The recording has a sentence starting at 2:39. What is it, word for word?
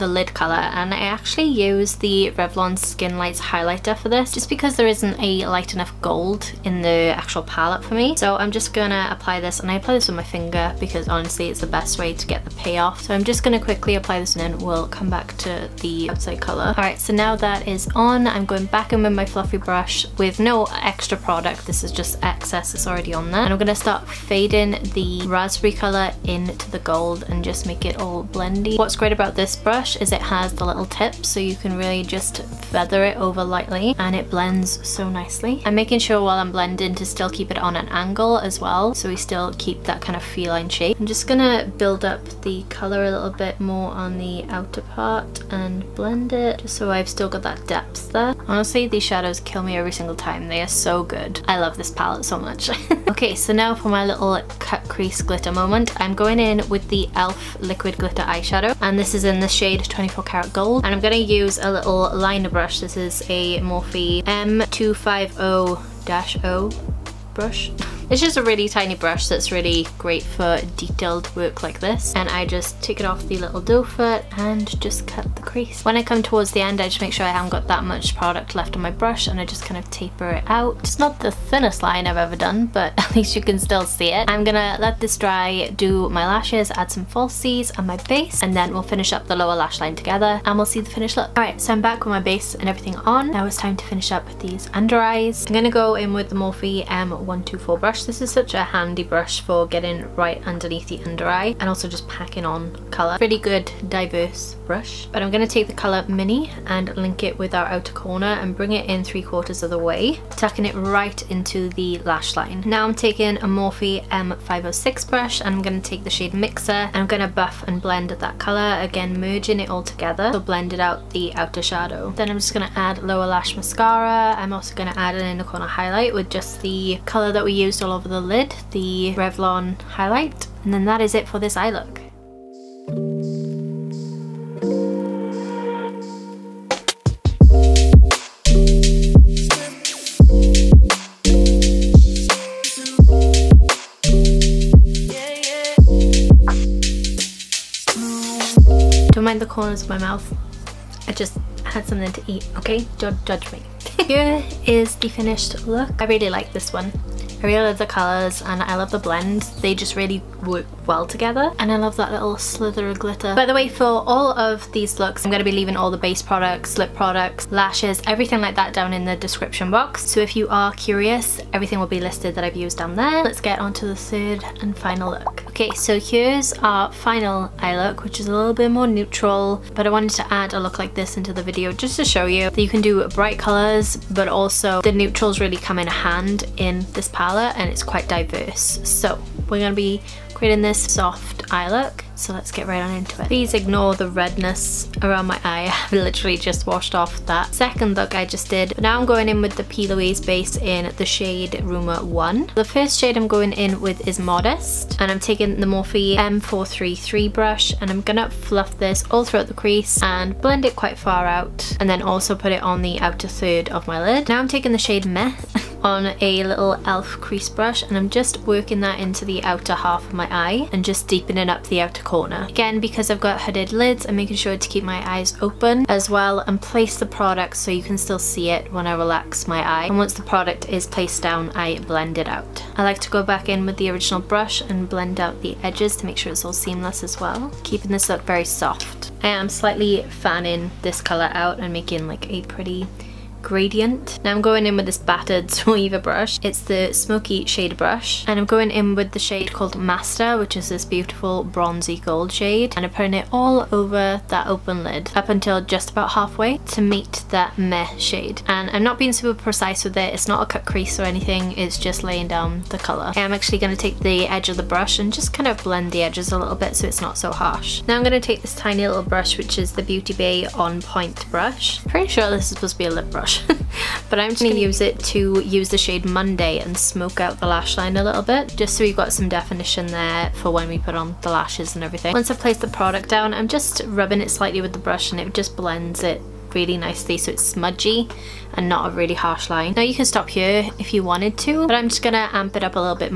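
They just really work well together.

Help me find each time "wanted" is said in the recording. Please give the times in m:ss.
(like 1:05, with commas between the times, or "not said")
2:59, 4:51.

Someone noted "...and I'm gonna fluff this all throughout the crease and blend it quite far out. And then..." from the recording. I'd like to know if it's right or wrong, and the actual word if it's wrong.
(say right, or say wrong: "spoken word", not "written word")
right.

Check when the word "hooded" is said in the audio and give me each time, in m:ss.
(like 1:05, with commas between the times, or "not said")
3:43.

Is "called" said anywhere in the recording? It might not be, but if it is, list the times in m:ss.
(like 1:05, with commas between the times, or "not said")
4:09.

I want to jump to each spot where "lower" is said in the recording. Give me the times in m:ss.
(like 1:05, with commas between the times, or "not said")
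1:29, 2:03.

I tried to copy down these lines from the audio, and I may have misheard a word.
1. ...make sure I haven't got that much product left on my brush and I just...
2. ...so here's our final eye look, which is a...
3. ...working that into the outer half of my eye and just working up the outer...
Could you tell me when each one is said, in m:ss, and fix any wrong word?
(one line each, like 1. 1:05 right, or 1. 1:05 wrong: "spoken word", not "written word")
1. 1:16 right
2. 2:55 right
3. 3:38 wrong: "deepening", not "working".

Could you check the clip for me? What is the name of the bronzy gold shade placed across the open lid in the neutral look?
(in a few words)
Master.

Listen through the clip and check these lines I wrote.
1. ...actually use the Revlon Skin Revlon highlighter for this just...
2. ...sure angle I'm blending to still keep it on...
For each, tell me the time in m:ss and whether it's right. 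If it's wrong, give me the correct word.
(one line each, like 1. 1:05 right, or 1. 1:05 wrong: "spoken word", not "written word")
1. 0:00 wrong: "Lights", not "Revlon"
2. 0:35 wrong: "while", not "angle".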